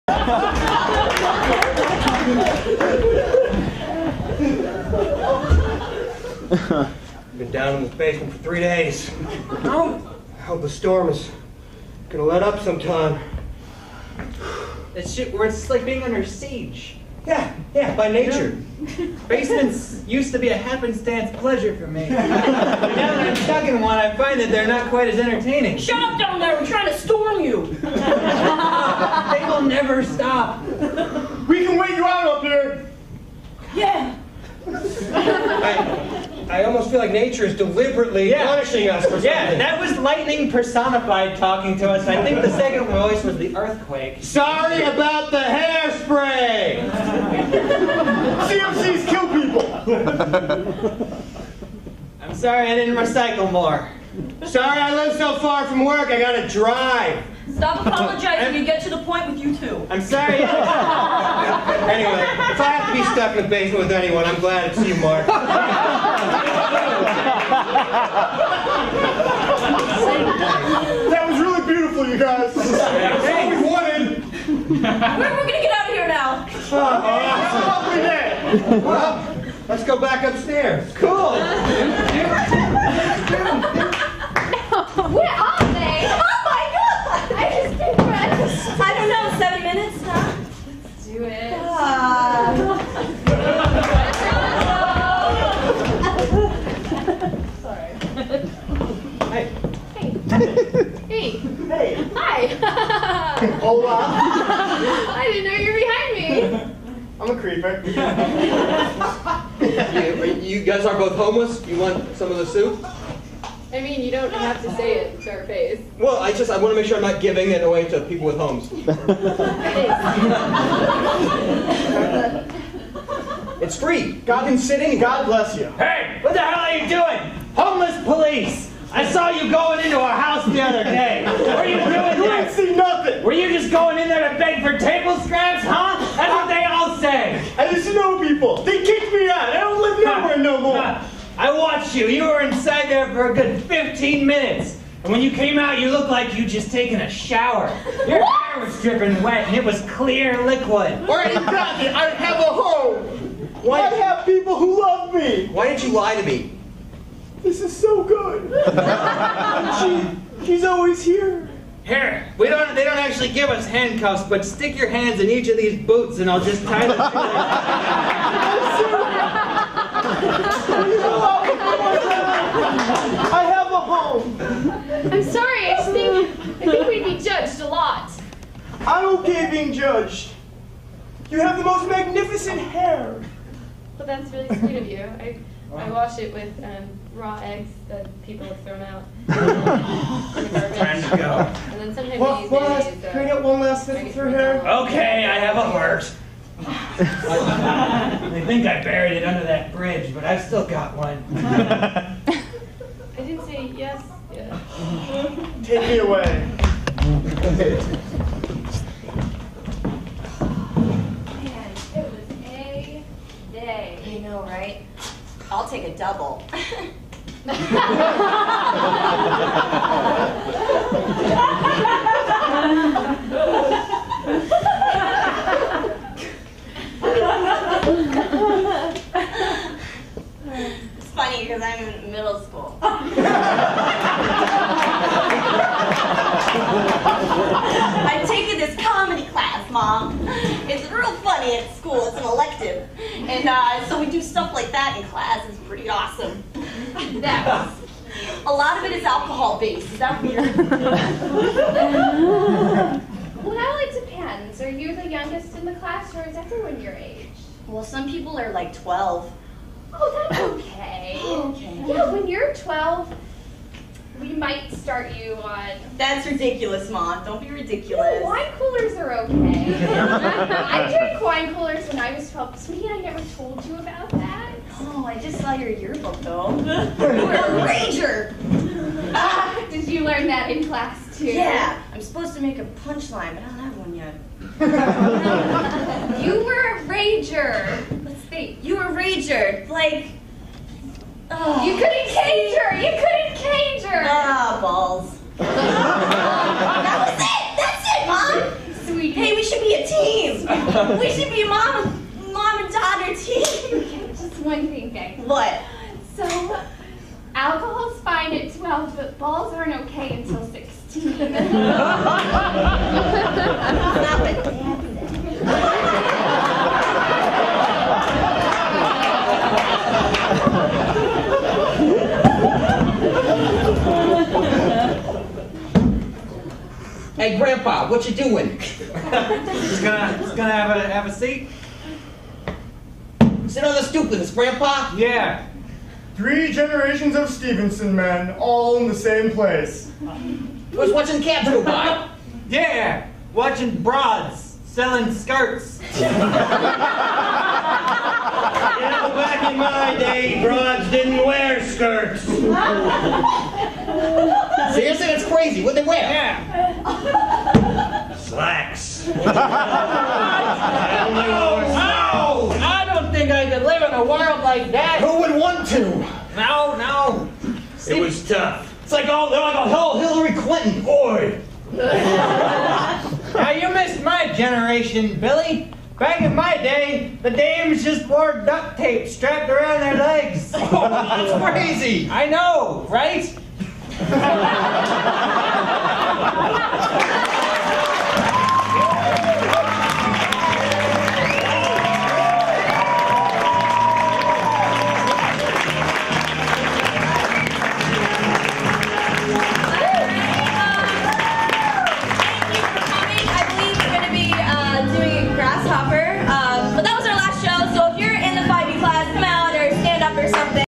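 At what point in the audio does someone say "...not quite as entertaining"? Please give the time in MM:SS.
00:24.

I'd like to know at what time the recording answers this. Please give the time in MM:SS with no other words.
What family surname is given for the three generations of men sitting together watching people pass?
05:37.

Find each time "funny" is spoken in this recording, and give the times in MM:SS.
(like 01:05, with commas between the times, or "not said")
03:51, 04:01.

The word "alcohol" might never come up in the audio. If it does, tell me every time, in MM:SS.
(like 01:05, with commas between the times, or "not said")
04:09, 05:07.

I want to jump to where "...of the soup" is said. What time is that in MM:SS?
01:52.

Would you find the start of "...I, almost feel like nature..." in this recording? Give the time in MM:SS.
00:36.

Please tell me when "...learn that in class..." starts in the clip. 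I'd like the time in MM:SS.
04:40.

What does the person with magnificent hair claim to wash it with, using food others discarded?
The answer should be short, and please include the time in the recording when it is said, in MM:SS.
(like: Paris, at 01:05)
raw eggs, at 03:07.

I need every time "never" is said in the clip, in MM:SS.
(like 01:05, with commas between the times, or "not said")
00:29, 04:32.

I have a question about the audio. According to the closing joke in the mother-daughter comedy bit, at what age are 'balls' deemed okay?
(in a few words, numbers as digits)
16.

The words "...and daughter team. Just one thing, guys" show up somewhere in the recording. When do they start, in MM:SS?
05:02.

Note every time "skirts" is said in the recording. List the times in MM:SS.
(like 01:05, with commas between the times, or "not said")
05:45, 05:51.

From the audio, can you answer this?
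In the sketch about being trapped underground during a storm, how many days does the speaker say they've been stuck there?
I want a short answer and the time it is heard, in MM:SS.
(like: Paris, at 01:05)
3, at 00:08.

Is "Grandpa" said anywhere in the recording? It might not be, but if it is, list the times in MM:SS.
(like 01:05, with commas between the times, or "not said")
05:27, 05:34.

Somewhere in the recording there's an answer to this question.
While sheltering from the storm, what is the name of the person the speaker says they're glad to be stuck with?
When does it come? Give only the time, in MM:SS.
01:04.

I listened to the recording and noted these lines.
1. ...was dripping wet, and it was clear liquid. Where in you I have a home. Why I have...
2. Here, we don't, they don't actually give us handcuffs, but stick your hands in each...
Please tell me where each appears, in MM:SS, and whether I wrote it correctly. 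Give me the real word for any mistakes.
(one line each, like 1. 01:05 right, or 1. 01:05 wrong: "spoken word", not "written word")
1. 02:28 right
2. 02:41 right.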